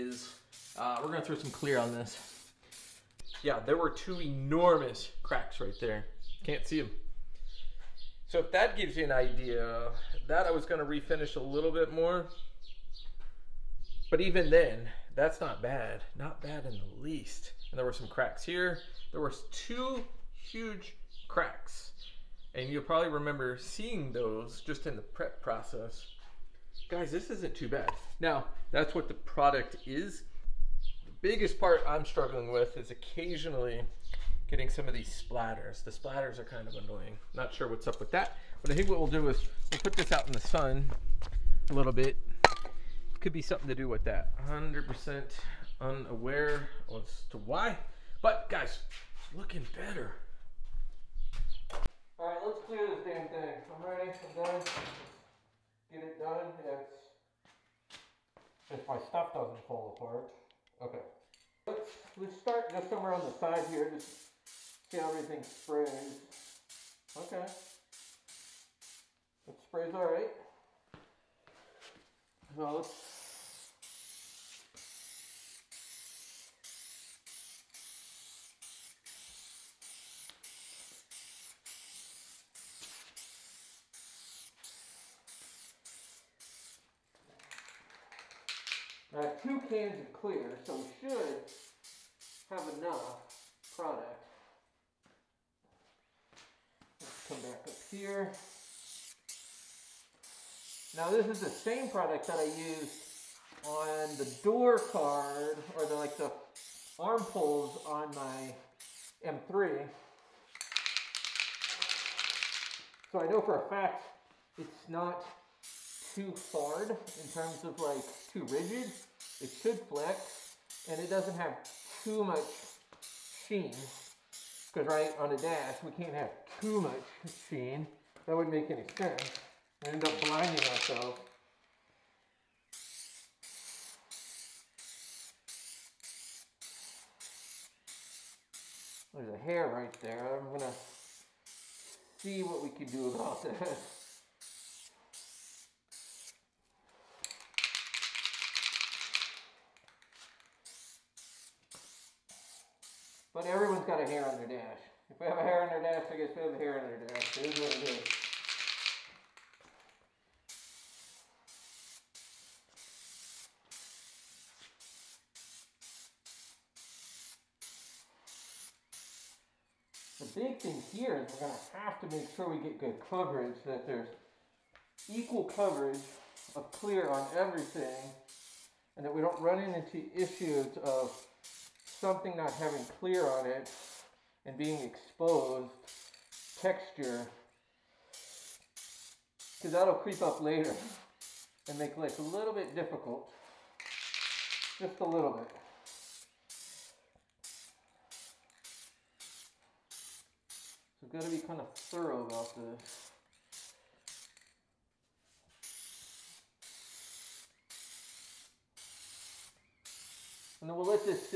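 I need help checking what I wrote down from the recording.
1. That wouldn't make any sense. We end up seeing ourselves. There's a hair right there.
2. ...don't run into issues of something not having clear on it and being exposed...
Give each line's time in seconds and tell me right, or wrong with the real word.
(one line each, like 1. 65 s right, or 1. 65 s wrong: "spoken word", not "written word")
1. 128 s wrong: "blinding", not "seeing"
2. 179 s right.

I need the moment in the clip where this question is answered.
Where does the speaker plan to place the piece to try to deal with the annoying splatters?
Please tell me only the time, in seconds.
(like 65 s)
40 s.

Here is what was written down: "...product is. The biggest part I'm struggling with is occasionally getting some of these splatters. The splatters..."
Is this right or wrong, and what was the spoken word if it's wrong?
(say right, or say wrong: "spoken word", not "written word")
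right.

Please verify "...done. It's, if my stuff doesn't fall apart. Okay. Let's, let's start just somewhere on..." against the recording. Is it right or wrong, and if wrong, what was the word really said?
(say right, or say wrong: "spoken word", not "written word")
right.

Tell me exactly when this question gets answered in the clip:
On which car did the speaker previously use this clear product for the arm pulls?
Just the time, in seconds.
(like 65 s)
109 s.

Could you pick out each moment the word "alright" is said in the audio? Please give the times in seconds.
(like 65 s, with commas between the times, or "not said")
52 s, 69 s.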